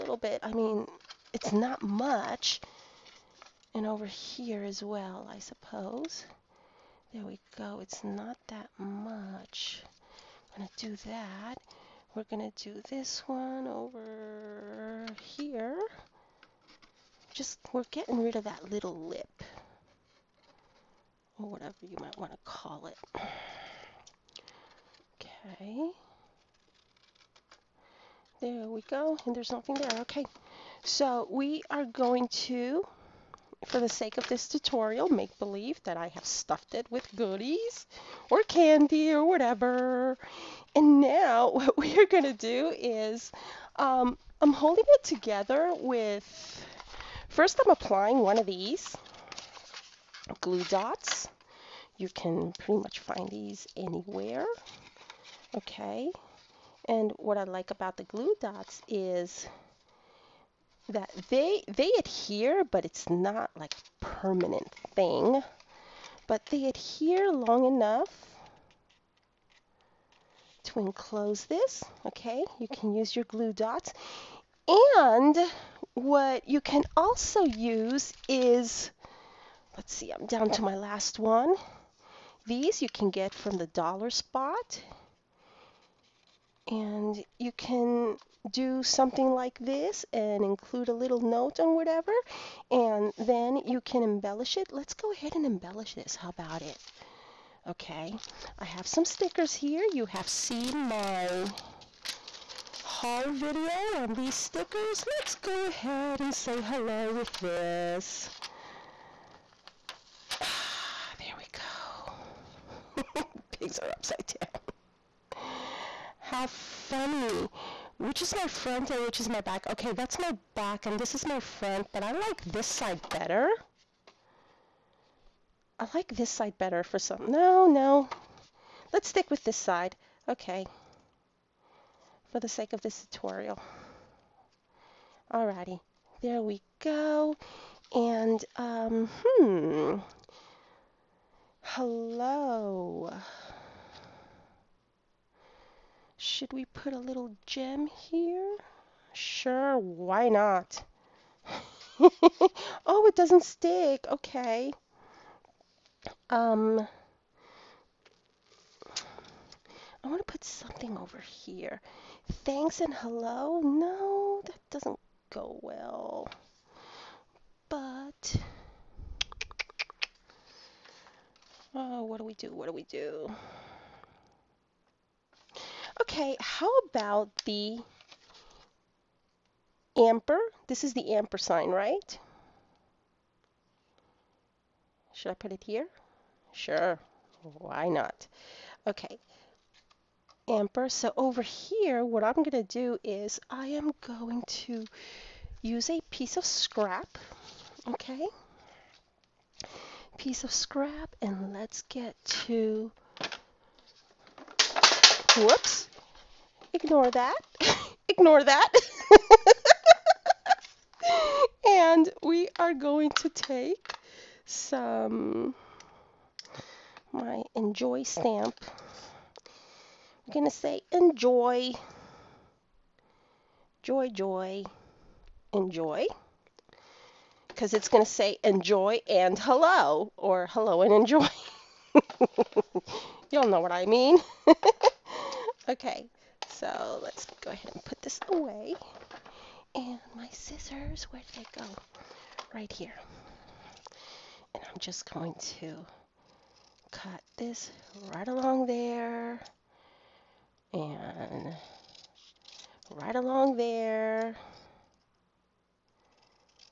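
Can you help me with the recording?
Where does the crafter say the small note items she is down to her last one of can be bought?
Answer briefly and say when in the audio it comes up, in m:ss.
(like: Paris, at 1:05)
the dollar spot, at 1:23.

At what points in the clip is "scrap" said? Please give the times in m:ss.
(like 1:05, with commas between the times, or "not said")
3:16, 3:20.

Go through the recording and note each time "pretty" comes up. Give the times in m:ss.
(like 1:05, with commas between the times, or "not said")
0:52.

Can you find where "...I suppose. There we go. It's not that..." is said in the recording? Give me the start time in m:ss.
0:05.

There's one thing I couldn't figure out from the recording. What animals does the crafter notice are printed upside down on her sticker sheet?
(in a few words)
Pigs.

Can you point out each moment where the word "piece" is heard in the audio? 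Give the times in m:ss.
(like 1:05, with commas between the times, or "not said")
3:16, 3:20.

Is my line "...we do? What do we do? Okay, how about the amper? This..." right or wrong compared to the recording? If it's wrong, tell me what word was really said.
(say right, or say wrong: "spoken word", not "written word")
right.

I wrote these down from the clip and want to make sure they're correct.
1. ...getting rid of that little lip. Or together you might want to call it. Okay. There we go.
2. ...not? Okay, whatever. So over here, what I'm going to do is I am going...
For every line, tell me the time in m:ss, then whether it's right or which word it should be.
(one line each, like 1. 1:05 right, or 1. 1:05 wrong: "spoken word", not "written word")
1. 0:17 wrong: "whatever", not "together"
2. 3:07 wrong: "amper", not "whatever".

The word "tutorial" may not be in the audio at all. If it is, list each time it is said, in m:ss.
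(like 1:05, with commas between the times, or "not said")
0:34, 2:13.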